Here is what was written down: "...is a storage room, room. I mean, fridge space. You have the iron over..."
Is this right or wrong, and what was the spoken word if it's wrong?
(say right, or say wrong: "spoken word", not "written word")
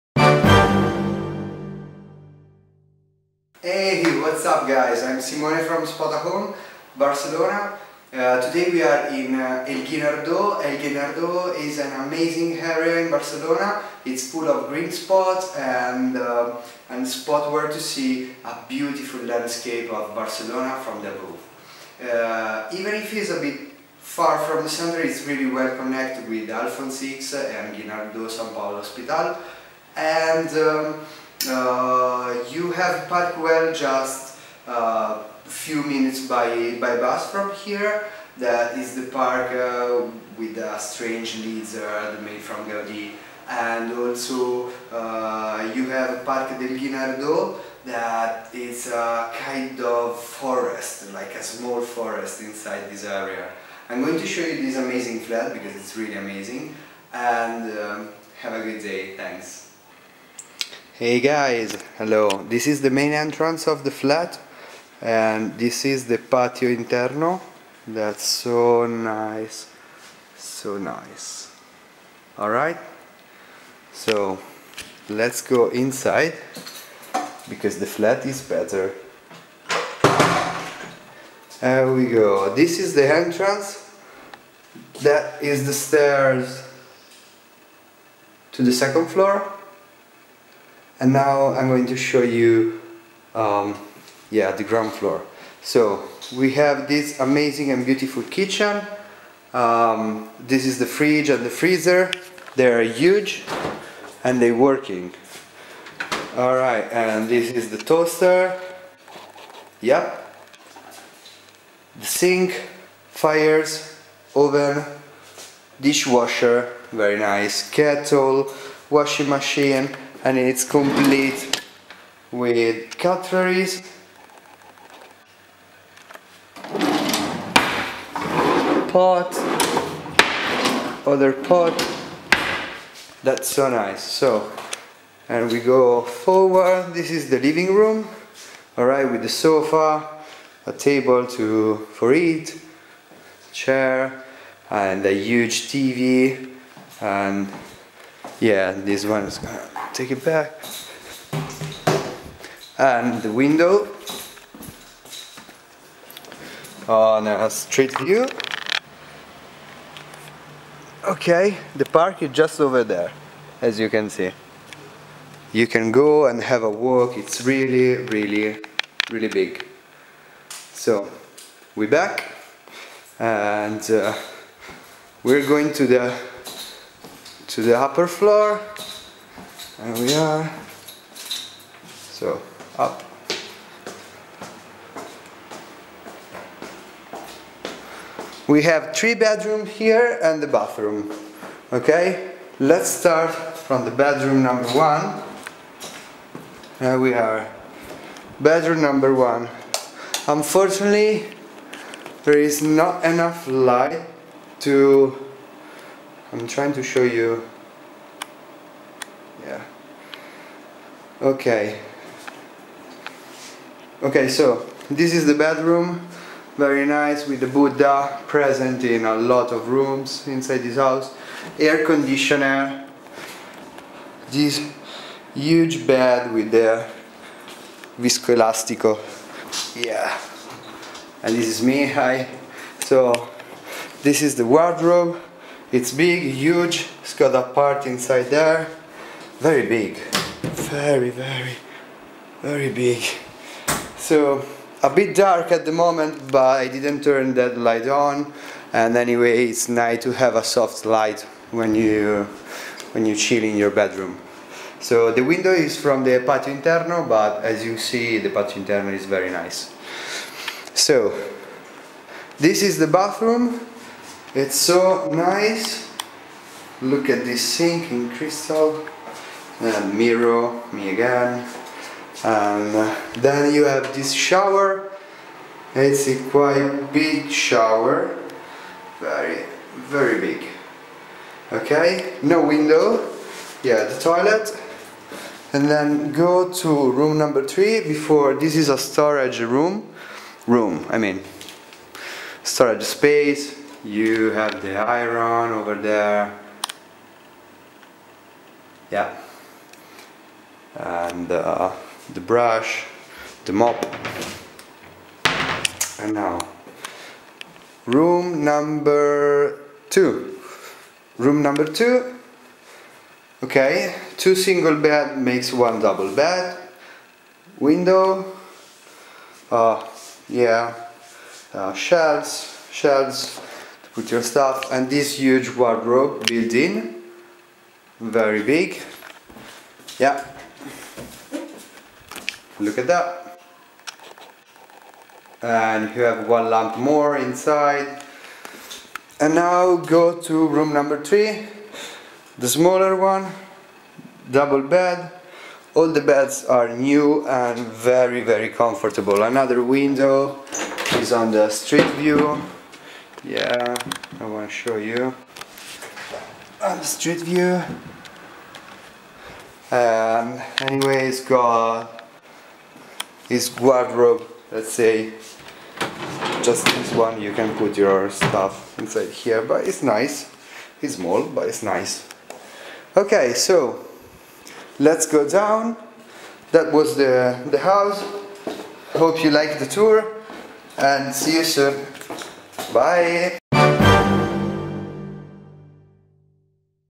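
wrong: "storage", not "fridge".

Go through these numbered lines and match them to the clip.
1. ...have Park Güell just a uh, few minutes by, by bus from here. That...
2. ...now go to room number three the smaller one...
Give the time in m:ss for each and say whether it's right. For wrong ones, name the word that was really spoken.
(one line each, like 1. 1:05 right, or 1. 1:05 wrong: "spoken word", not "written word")
1. 0:32 right
2. 5:39 right.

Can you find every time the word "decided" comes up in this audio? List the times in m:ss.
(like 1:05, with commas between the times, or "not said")
not said.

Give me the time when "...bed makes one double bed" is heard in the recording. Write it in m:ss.
5:14.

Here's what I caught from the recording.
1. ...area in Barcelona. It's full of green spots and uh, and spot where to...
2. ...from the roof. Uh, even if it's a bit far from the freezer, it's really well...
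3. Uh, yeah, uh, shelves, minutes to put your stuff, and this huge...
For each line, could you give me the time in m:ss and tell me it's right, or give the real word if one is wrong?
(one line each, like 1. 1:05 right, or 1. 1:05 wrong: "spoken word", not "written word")
1. 0:12 right
2. 0:20 wrong: "center", not "freezer"
3. 5:19 wrong: "shelves", not "minutes".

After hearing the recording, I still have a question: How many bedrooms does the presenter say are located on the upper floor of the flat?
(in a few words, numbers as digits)
3.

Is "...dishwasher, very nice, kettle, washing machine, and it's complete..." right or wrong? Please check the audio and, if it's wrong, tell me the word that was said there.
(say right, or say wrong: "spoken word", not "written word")
right.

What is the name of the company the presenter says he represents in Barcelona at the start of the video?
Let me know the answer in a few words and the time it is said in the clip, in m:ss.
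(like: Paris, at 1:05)
Spotahome, at 0:05.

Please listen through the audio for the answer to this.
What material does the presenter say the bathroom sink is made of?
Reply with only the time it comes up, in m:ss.
4:28.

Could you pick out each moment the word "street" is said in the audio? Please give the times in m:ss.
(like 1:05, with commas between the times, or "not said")
2:37, 5:51, 5:56.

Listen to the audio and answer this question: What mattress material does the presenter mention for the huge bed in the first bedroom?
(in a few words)
viscoelastico.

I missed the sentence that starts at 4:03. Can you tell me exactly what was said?
So a bit dark at the moment, but I didn't turn that light on.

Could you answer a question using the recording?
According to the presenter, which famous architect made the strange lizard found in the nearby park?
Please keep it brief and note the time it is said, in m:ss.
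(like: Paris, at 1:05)
Gaudi, at 0:42.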